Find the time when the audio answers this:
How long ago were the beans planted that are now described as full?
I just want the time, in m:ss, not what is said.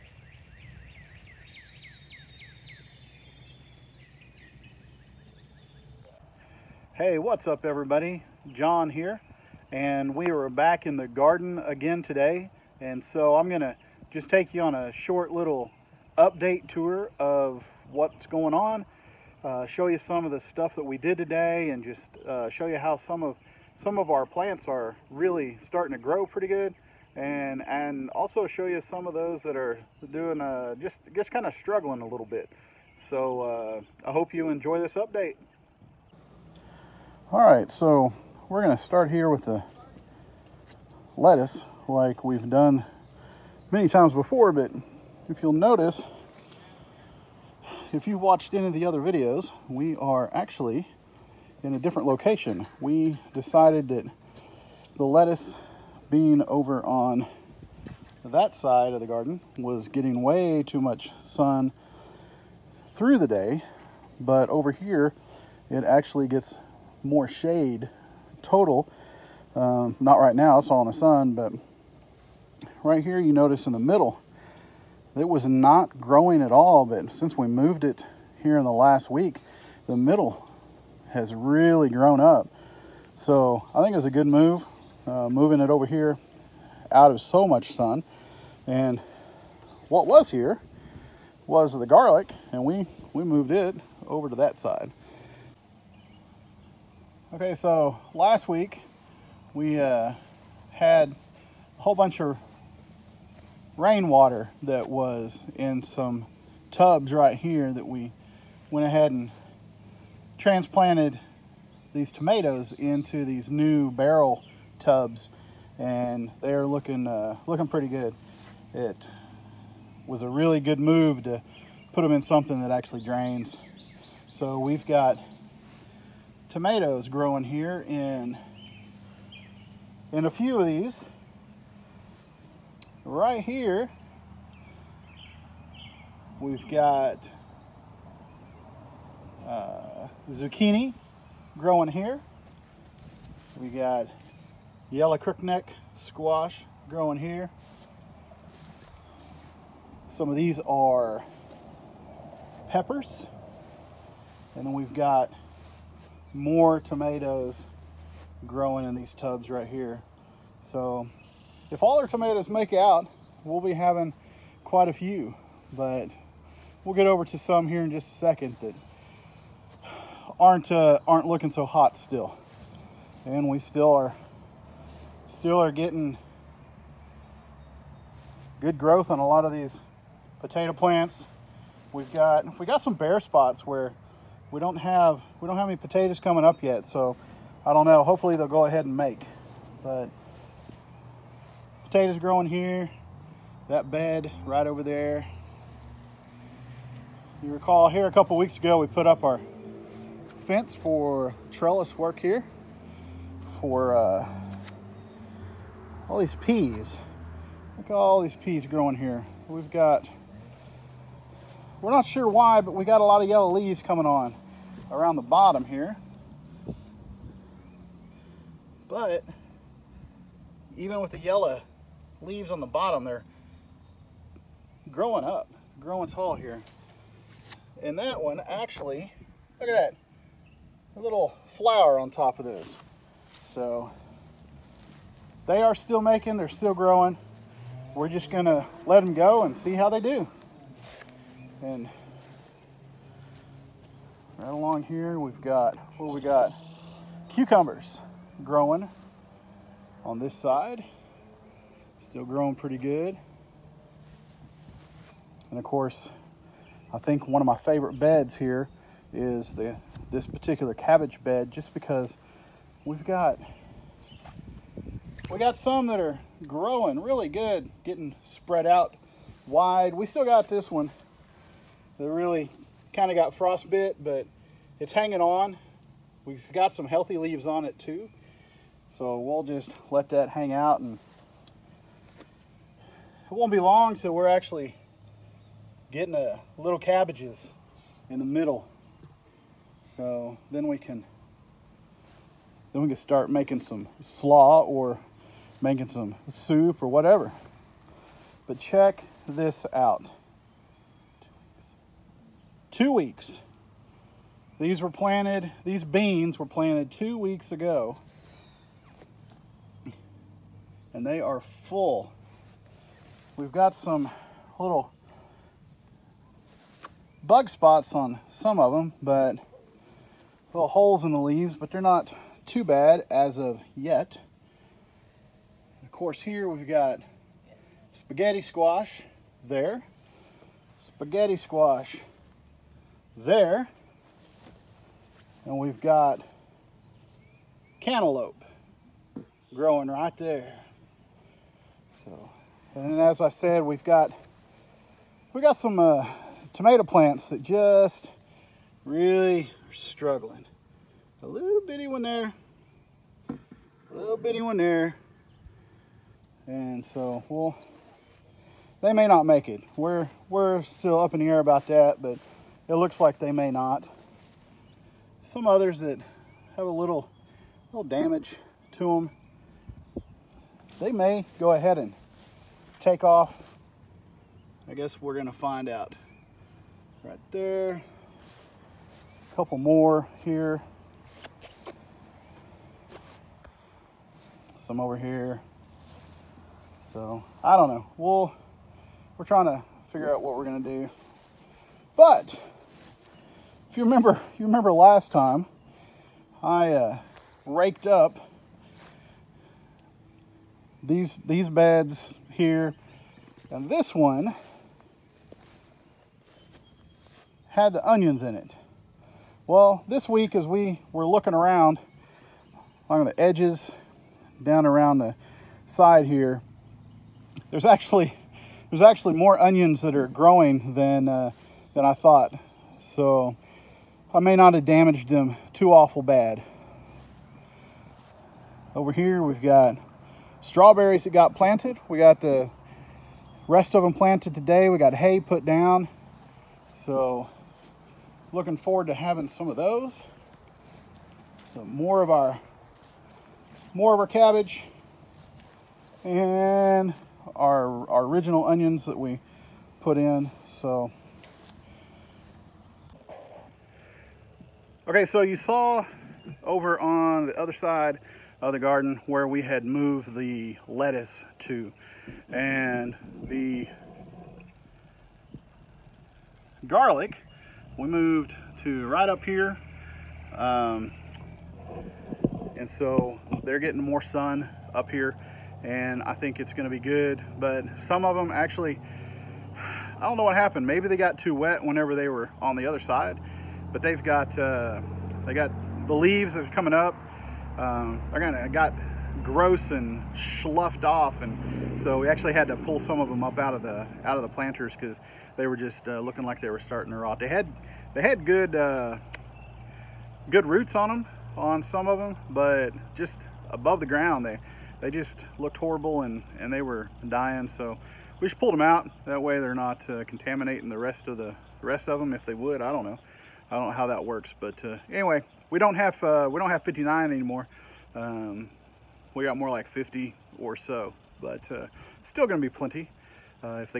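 5:06.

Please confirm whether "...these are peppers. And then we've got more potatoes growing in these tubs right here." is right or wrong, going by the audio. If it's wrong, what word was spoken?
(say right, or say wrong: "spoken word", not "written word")
wrong: "tomatoes", not "potatoes".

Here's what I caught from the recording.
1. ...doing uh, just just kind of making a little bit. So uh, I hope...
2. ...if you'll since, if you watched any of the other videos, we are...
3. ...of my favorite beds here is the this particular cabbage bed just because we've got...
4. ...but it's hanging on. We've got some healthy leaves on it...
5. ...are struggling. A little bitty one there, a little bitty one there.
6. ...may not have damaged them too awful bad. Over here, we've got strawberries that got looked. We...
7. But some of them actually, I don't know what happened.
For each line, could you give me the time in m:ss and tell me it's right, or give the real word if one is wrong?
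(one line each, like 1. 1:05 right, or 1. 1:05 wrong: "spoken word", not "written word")
1. 0:30 wrong: "struggling", not "making"
2. 0:45 wrong: "notice", not "since"
3. 4:17 right
4. 4:34 right
5. 5:49 right
6. 7:04 wrong: "planted", not "looked"
7. 7:57 right.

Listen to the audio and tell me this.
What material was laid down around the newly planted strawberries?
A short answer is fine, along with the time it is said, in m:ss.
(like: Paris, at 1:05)
Hay, at 7:14.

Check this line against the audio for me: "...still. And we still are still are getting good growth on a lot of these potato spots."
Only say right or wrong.
wrong.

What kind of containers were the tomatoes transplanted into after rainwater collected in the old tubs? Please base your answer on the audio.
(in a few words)
Barrel tubs.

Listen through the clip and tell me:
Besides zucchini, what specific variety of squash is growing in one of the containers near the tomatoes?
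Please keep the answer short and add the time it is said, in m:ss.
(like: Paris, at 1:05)
Yellow crookneck squash, at 2:24.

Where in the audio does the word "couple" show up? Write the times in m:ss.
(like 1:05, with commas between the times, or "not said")
3:18, 6:19.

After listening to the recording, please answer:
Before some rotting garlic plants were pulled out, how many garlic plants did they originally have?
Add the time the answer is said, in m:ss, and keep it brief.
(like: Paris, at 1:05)
59, at 8:36.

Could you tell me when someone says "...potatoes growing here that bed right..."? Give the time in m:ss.
3:11.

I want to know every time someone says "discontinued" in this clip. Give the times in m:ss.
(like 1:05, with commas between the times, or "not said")
not said.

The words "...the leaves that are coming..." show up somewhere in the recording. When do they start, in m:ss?
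8:05.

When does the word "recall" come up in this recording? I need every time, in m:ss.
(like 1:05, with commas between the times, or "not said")
3:17.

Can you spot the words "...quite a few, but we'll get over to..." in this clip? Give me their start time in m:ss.
2:44.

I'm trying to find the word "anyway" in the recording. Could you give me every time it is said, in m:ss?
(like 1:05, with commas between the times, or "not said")
8:34.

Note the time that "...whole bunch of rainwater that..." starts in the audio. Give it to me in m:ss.
1:41.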